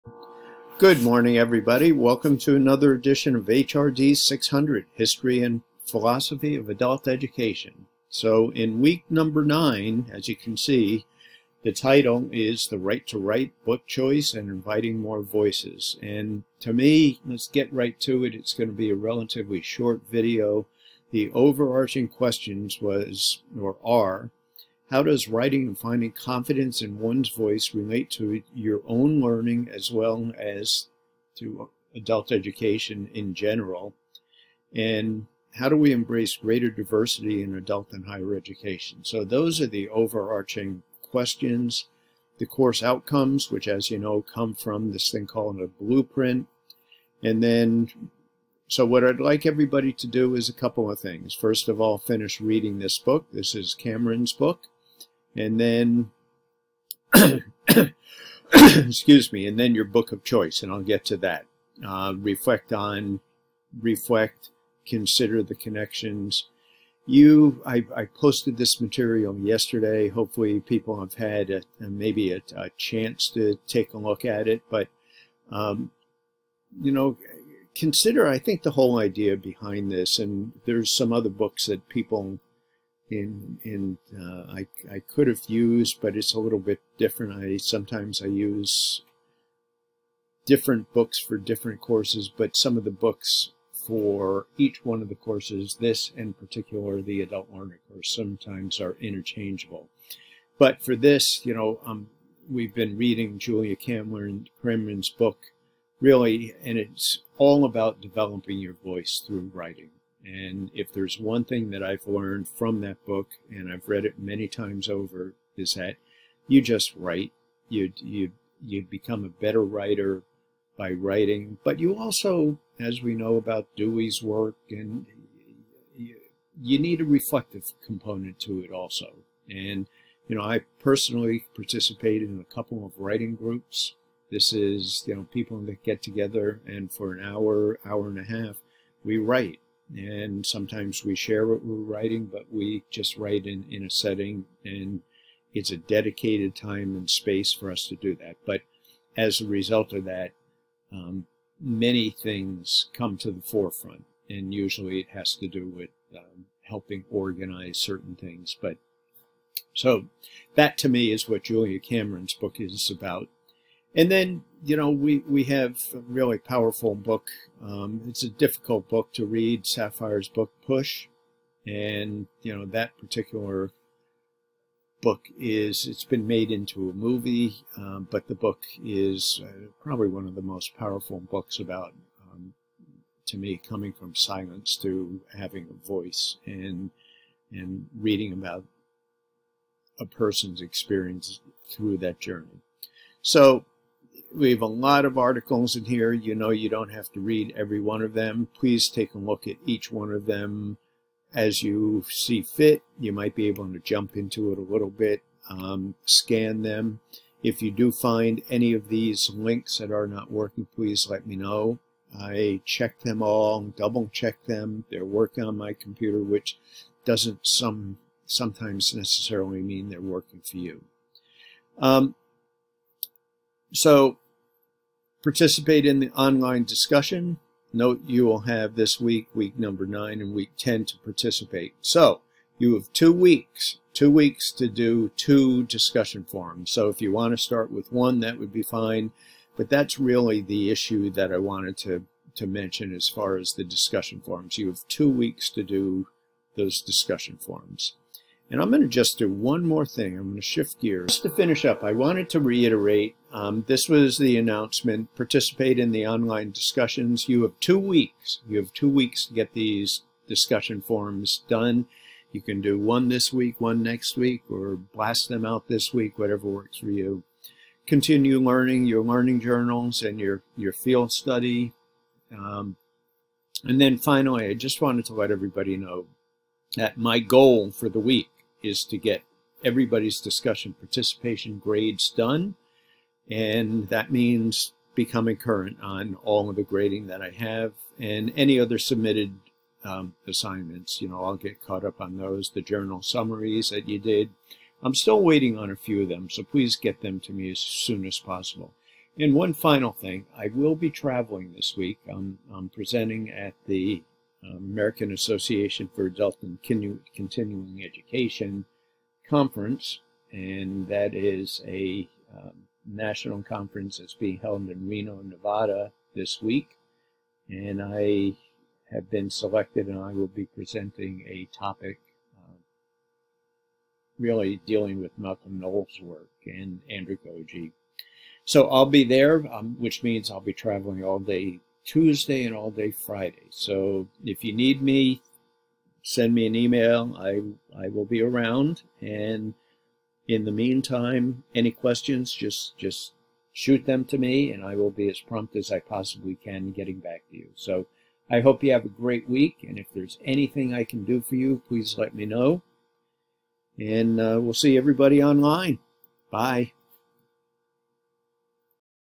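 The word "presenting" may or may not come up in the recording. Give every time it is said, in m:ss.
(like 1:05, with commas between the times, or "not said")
5:02, 5:20.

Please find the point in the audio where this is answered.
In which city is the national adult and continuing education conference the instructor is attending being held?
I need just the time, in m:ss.
5:14.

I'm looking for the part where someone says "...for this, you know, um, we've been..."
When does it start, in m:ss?
1:40.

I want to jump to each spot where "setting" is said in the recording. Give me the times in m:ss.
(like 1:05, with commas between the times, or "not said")
2:23.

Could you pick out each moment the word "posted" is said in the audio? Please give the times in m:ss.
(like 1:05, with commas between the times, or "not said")
1:08.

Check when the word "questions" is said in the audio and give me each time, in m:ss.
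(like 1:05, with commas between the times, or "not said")
0:22, 0:41, 5:41.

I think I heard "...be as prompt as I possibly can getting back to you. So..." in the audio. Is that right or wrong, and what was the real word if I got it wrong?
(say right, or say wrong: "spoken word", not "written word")
right.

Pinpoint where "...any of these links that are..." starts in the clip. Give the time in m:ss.
3:28.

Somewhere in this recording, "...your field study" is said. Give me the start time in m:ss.
4:30.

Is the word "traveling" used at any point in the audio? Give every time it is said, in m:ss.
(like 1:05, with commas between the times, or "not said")
5:00, 5:30.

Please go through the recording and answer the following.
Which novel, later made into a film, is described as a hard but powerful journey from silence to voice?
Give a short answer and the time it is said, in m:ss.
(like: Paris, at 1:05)
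Push, at 2:50.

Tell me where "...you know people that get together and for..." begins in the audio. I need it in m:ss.
2:15.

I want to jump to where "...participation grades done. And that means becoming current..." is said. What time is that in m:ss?
4:40.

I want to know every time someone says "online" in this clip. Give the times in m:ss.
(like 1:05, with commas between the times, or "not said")
3:46, 4:16, 5:55.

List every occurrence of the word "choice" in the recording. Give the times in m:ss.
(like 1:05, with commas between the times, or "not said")
0:13, 1:00.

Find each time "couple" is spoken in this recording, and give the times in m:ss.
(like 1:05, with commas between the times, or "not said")
0:50, 2:12.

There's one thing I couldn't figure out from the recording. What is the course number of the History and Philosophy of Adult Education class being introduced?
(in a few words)
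HRD 600.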